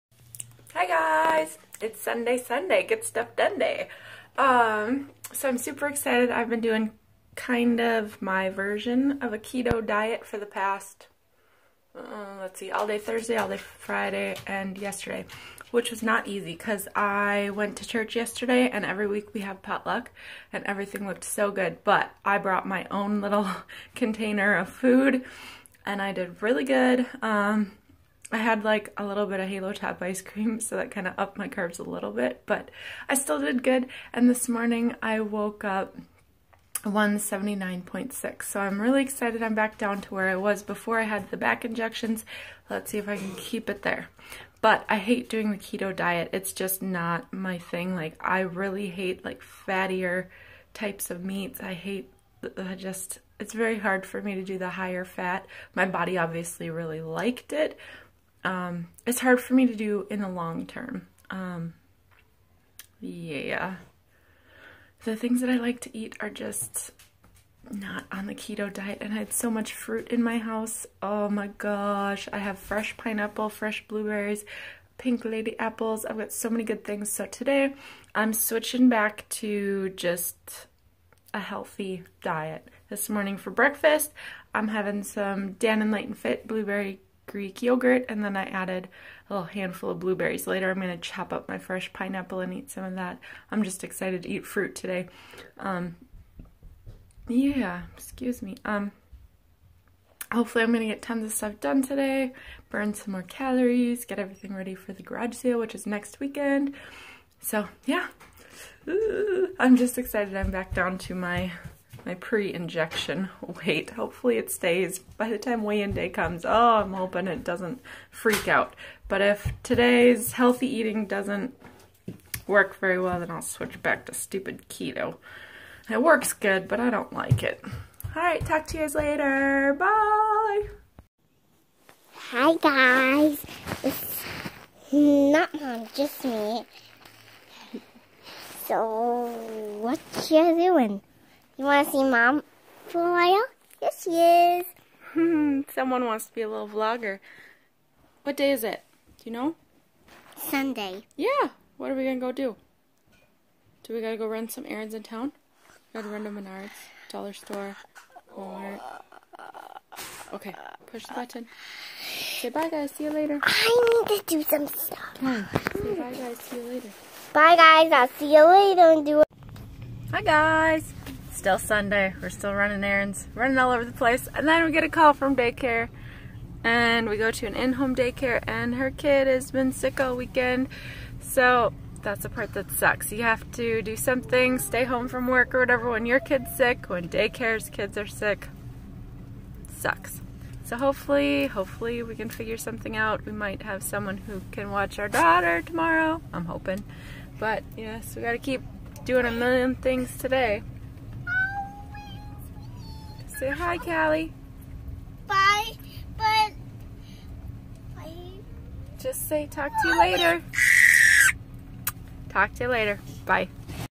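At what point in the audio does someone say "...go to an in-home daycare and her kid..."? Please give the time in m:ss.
2:57.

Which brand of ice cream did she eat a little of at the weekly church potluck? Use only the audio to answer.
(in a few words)
Halo Top.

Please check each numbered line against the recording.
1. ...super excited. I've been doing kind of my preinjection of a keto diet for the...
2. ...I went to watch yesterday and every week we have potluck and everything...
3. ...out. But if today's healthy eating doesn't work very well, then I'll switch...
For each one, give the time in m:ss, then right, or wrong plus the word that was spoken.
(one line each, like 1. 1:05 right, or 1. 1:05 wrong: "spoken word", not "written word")
1. 0:05 wrong: "version", not "preinjection"
2. 0:16 wrong: "church", not "watch"
3. 1:58 right.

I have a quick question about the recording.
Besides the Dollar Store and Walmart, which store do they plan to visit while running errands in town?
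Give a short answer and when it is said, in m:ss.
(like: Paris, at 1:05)
Menards, at 2:36.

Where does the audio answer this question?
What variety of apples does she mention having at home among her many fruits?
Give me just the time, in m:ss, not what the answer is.
1:14.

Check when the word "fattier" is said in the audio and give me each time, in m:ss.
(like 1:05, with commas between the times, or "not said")
0:49.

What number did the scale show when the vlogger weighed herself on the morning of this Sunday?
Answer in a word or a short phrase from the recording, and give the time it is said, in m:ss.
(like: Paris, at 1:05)
179.6, at 0:36.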